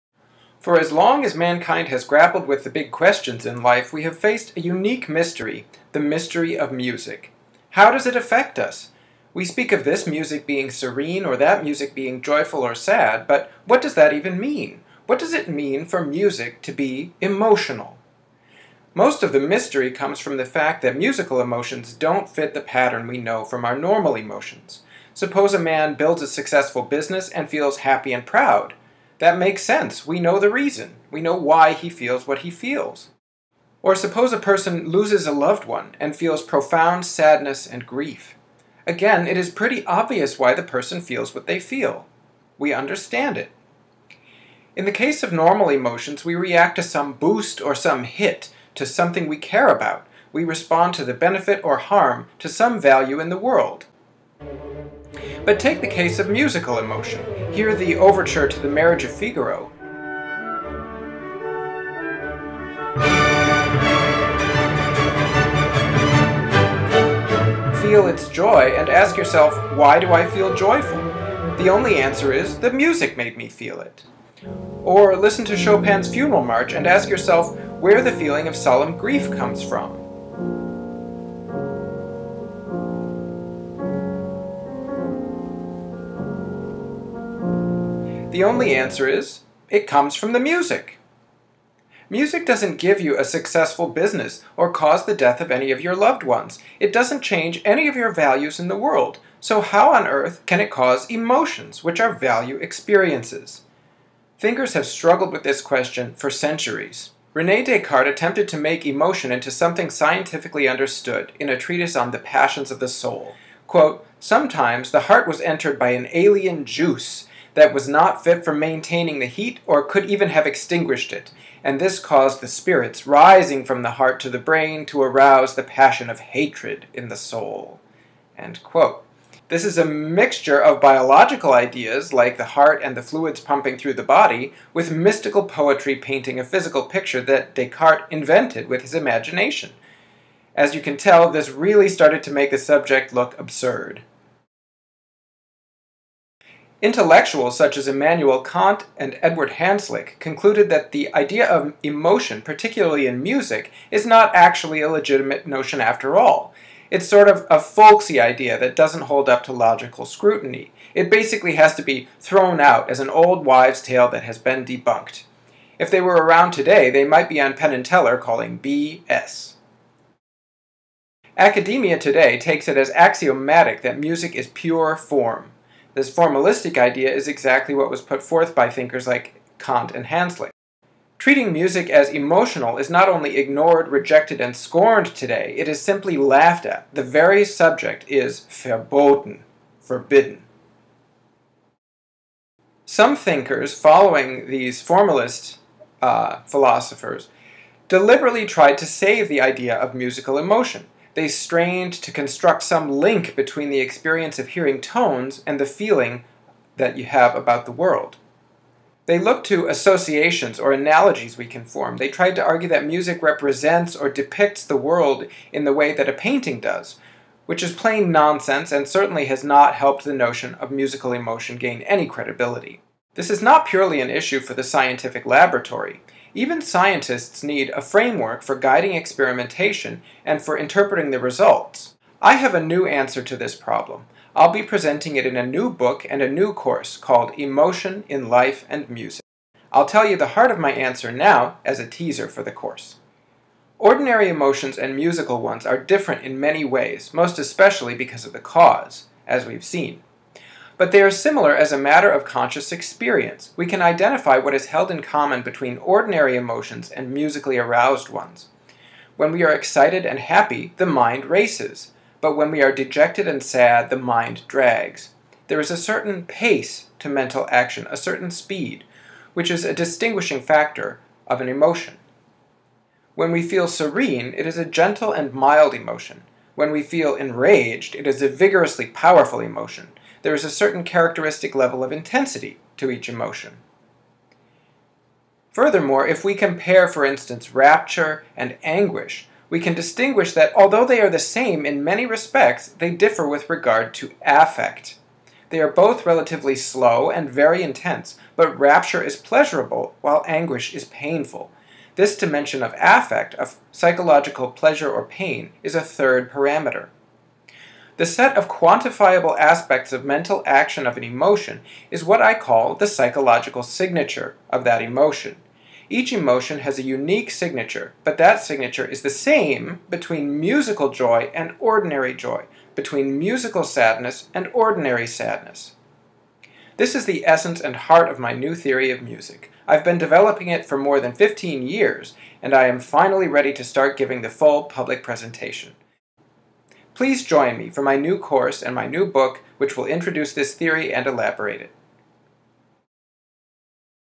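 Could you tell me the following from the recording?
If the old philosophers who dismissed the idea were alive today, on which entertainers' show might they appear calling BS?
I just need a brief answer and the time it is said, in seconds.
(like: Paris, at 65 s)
Penn and Teller, at 167 s.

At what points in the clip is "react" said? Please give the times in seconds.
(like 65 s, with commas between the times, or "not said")
46 s.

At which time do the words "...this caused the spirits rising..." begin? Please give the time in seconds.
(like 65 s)
121 s.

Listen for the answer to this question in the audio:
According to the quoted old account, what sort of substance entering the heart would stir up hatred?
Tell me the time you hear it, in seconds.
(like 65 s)
116 s.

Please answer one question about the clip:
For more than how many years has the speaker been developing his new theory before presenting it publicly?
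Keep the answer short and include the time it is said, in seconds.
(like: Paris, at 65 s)
15, at 331 s.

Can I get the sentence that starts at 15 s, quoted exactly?
What does it mean for music to be emotional?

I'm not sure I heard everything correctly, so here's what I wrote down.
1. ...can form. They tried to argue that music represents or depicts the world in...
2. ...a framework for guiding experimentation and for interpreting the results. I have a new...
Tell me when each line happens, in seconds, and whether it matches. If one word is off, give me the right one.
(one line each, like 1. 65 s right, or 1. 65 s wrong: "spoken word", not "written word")
1. 211 s right
2. 227 s right.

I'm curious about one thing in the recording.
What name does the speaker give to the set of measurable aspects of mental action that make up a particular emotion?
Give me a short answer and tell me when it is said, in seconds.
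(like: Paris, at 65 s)
psychological signature, at 312 s.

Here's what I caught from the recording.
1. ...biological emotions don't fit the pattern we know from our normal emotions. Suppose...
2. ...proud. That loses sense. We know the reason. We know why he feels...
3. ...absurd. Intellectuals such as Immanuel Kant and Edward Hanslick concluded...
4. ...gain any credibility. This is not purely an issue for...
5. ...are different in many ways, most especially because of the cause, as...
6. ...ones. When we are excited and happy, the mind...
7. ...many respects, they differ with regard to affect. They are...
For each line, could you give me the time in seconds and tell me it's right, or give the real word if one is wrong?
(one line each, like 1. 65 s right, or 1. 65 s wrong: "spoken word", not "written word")
1. 20 s wrong: "musical", not "biological"
2. 28 s wrong: "makes", not "loses"
3. 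143 s right
4. 221 s right
5. 245 s right
6. 258 s right
7. 291 s right.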